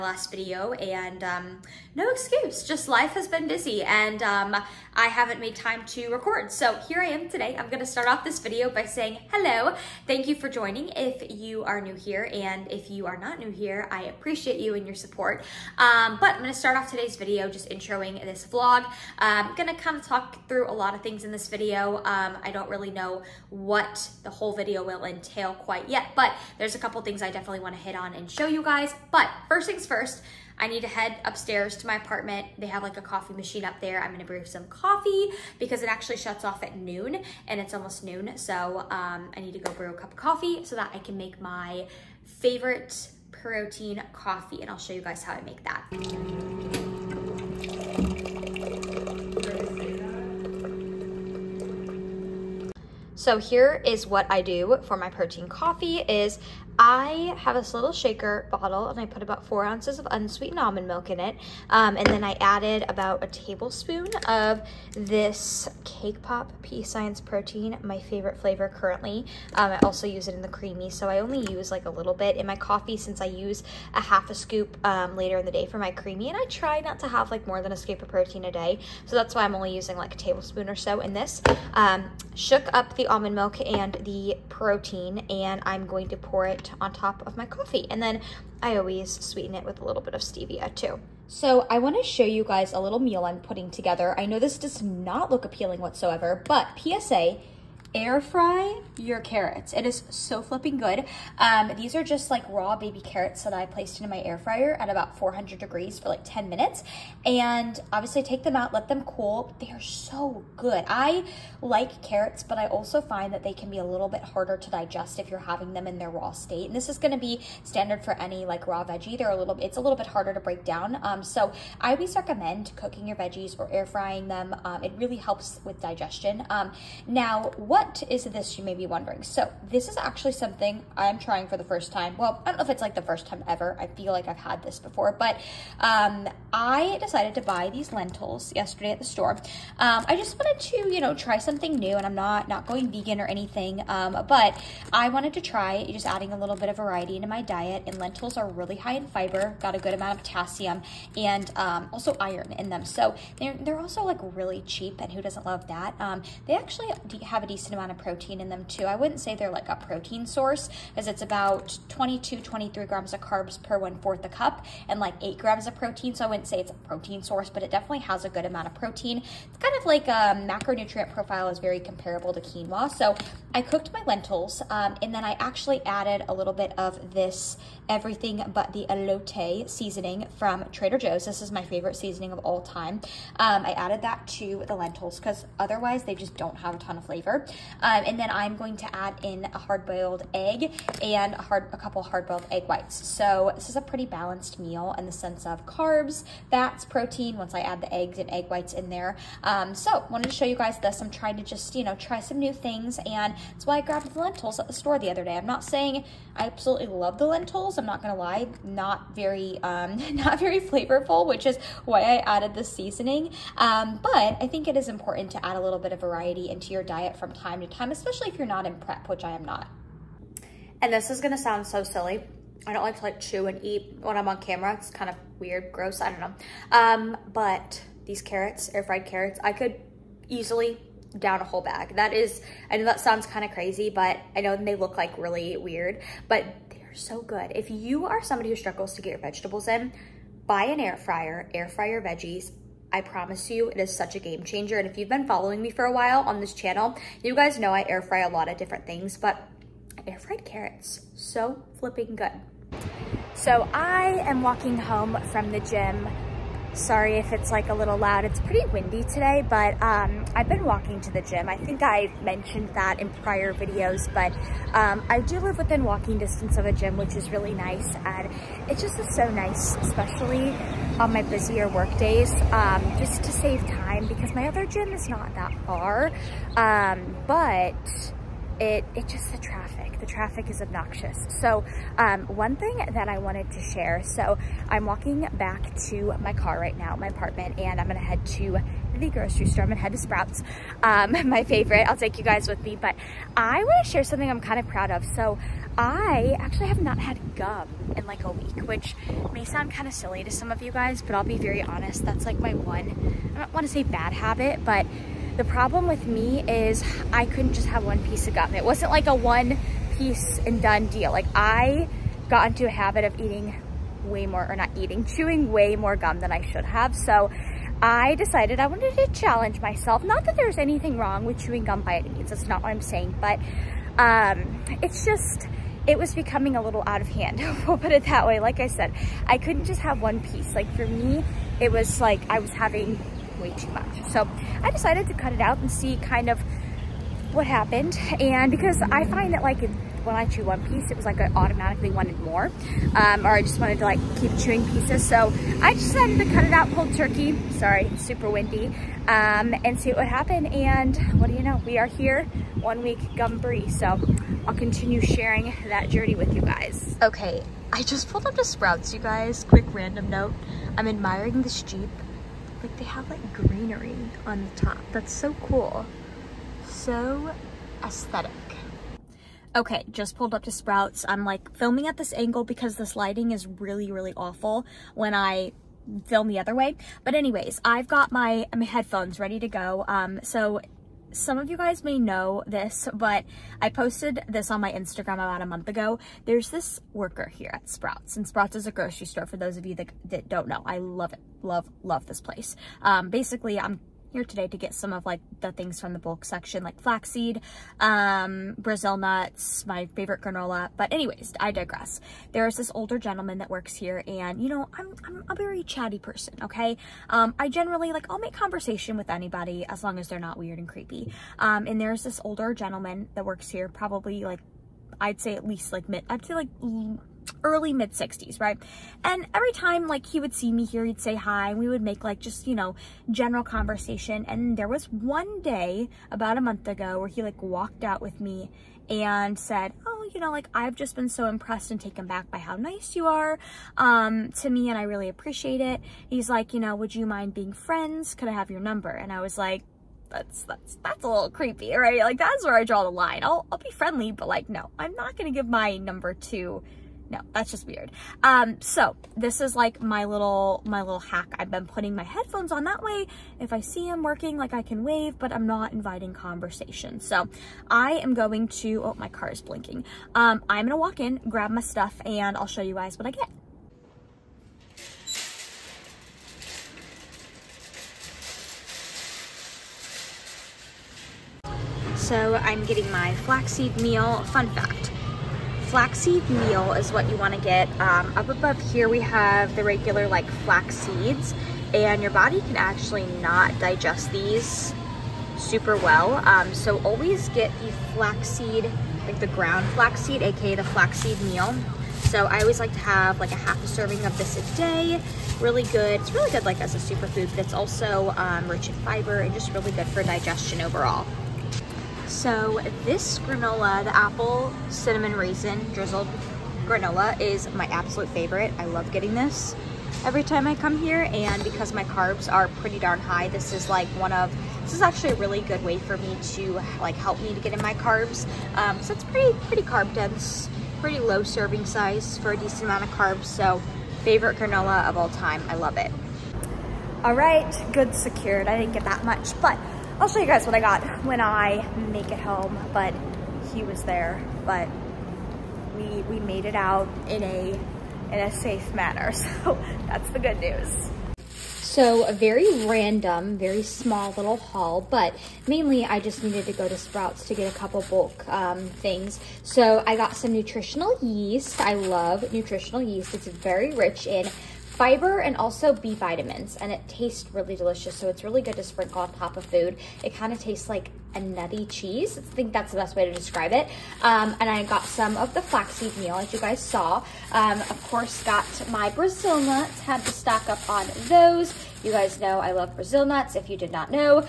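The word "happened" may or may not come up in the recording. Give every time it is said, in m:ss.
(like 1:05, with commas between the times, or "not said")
5:37, 5:50.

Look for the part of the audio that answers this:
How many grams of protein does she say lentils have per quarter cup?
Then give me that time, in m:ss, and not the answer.
2:45.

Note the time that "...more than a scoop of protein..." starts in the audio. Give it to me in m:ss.
1:17.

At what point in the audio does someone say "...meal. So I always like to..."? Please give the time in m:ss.
8:11.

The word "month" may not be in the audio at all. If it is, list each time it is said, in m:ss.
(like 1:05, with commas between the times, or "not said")
6:25, 7:06.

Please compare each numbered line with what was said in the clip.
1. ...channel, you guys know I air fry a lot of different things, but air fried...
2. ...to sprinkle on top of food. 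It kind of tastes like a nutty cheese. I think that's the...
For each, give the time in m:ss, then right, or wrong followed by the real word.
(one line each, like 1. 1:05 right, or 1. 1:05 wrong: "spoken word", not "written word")
1. 4:06 right
2. 9:18 right.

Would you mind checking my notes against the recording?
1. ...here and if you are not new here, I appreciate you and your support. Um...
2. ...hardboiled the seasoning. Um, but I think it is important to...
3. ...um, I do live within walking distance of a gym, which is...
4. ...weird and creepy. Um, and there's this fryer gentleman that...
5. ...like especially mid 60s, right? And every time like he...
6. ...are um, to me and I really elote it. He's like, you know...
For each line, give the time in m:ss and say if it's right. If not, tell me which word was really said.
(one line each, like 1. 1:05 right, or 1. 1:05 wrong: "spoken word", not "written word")
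1. 0:11 right
2. 3:32 wrong: "added", not "hardboiled"
3. 4:24 right
4. 6:50 wrong: "older", not "fryer"
5. 6:56 wrong: "early", not "especially"
6. 7:13 wrong: "appreciate", not "elote".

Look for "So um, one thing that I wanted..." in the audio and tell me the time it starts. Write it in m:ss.
4:41.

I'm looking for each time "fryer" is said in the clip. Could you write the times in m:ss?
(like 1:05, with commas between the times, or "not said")
1:44, 4:00.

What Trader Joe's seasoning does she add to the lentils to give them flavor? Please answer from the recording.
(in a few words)
everything but the elote.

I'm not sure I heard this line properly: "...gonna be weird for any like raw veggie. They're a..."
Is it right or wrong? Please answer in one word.
wrong.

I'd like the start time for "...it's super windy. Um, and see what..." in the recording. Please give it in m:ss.
5:47.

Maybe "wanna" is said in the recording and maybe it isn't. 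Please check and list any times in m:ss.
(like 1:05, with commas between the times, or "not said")
0:27, 1:31, 4:53, 5:03.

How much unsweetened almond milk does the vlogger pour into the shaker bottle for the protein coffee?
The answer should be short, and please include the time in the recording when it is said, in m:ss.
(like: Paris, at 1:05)
4 ounces, at 0:59.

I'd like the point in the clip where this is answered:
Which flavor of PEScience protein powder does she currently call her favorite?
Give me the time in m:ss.
1:05.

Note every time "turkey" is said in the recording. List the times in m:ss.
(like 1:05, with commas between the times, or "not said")
5:46.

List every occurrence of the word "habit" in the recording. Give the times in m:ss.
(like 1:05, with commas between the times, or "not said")
5:04, 5:12.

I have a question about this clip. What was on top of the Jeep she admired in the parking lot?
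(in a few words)
greenery.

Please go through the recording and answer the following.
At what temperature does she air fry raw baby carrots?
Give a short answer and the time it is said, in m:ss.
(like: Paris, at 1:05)
400 degrees, at 1:45.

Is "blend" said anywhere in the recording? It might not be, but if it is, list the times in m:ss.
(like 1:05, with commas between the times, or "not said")
not said.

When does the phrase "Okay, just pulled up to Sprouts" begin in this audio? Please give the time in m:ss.
6:09.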